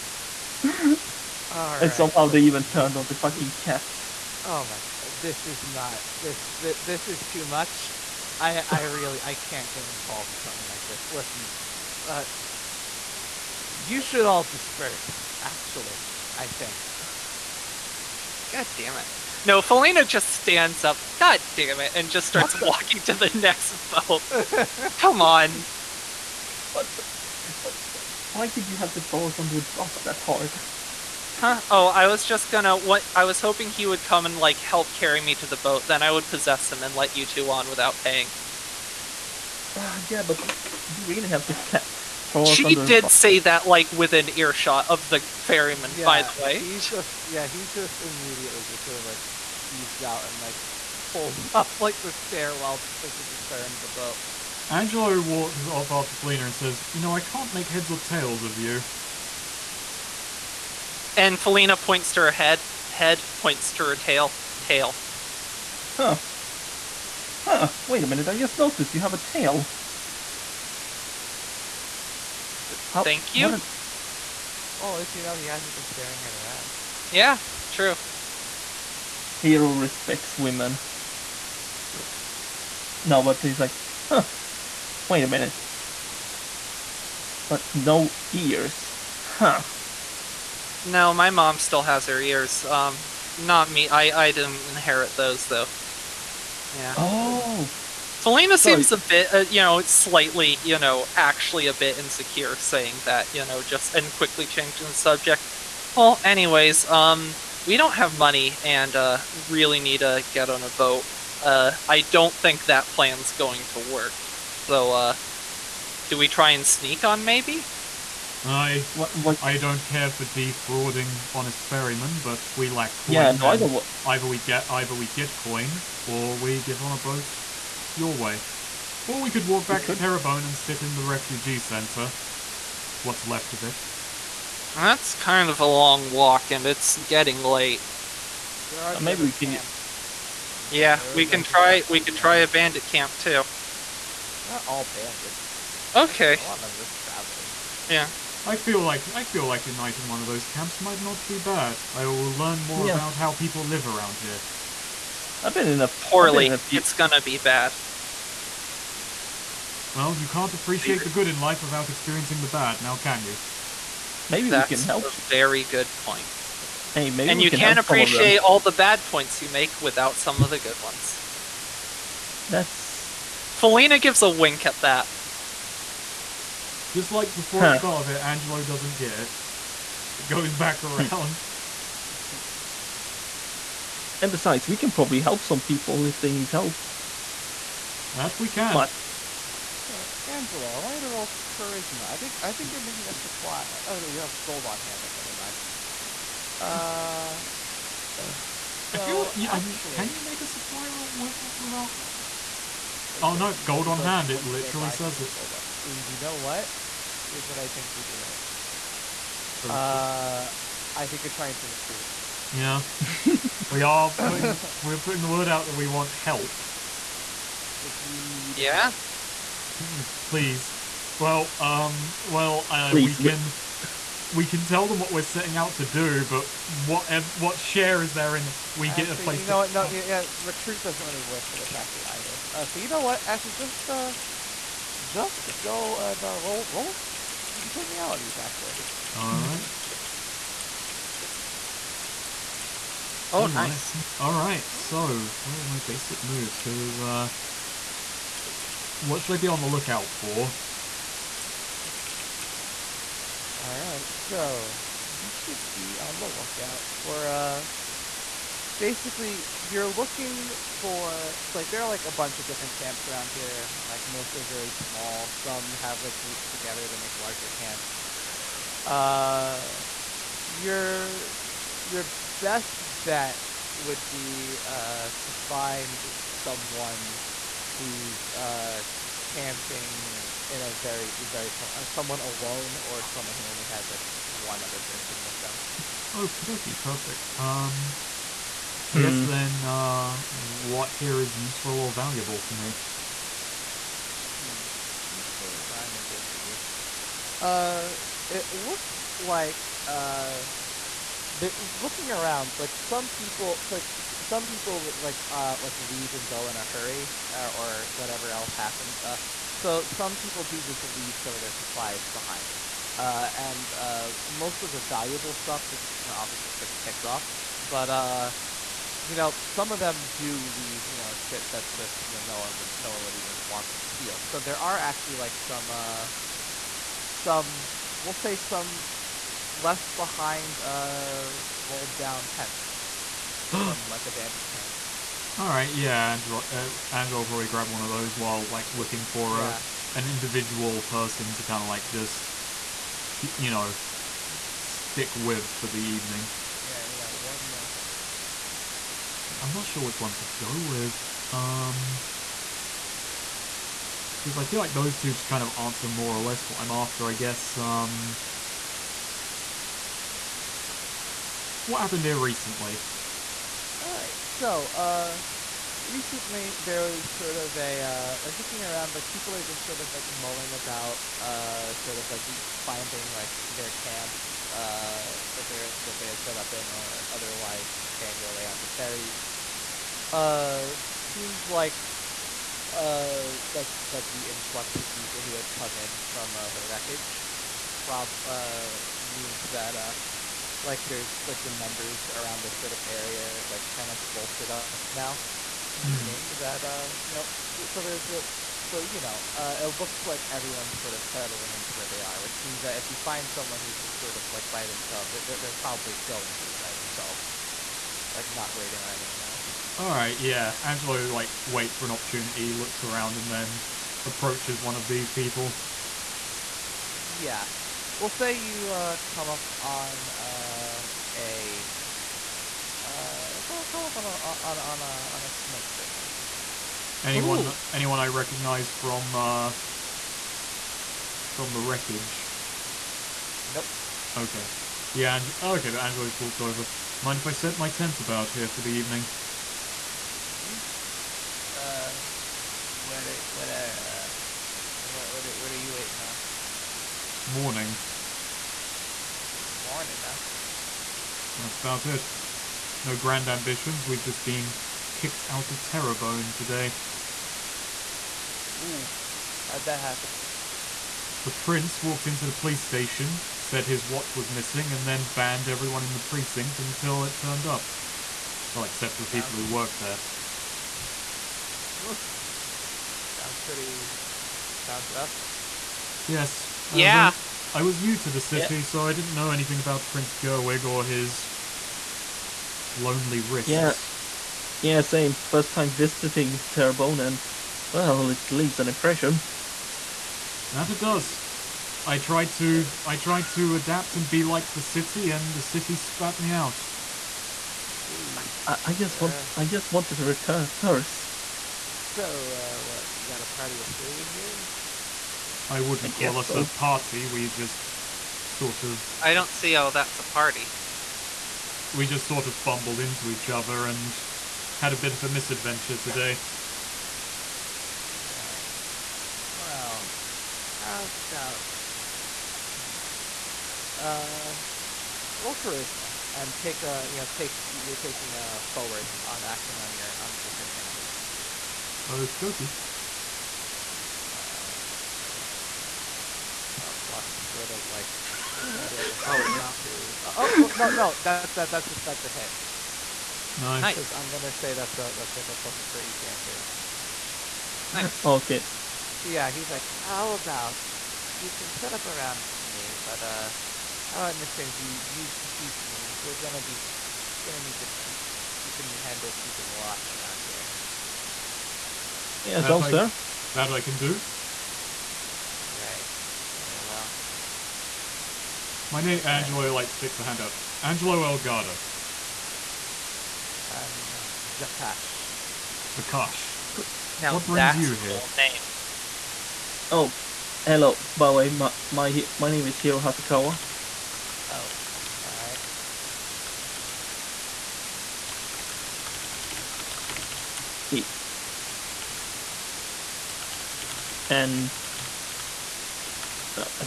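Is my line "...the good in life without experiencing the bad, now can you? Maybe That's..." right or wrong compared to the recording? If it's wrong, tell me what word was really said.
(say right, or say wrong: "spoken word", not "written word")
right.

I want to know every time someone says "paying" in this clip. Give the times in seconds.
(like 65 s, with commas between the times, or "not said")
37 s, 377 s.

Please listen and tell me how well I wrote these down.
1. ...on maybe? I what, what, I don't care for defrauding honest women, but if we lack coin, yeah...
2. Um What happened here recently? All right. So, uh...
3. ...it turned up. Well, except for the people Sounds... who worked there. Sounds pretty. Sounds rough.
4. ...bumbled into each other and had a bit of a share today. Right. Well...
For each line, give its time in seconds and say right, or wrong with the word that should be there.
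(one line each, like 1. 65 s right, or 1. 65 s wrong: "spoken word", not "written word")
1. 117 s wrong: "ferrymen", not "women"
2. 357 s right
3. 467 s right
4. 512 s wrong: "misadventure", not "share".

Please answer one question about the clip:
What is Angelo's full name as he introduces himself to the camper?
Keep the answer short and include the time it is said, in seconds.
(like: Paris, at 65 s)
Angelo Elgato, at 570 s.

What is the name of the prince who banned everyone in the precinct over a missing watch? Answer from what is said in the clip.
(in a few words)
Prince Gerwig.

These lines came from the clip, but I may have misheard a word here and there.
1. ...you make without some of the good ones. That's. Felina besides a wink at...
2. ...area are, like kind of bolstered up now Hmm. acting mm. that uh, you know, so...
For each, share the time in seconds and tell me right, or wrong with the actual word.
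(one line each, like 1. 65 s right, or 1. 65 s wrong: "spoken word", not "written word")
1. 169 s wrong: "gives", not "besides"
2. 392 s wrong: "meaning", not "acting".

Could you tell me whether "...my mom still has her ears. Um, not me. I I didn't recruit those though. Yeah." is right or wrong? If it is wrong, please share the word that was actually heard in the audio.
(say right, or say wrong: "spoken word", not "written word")
wrong: "inherit", not "recruit".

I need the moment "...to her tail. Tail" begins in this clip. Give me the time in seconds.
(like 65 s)
63 s.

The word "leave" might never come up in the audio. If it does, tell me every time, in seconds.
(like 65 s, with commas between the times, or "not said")
305 s, 310 s, 320 s, 488 s.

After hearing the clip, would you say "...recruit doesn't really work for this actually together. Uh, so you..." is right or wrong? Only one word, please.
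wrong.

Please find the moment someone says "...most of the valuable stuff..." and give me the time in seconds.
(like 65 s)
314 s.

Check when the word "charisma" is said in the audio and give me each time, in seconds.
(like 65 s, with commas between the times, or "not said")
191 s, 525 s.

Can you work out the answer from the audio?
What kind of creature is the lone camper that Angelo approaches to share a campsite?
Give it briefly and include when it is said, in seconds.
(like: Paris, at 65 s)
A snake person, at 425 s.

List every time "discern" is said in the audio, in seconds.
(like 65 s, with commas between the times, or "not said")
237 s, 530 s.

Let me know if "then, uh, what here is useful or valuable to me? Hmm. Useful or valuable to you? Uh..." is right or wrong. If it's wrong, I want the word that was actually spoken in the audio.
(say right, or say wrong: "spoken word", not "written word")
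right.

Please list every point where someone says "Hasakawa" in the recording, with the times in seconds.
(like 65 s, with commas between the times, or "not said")
582 s.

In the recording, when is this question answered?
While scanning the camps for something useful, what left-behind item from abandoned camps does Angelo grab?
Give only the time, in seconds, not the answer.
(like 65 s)
331 s.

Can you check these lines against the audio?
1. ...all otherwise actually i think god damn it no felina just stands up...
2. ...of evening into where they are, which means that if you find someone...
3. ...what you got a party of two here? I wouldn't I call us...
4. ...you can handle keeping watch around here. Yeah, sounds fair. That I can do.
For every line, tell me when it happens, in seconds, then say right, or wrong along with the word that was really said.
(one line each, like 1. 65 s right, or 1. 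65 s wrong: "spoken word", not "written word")
1. 14 s wrong: "disperse", not "otherwise"
2. 400 s wrong: "settling", not "evening"
3. 502 s wrong: "three", not "two"
4. 558 s right.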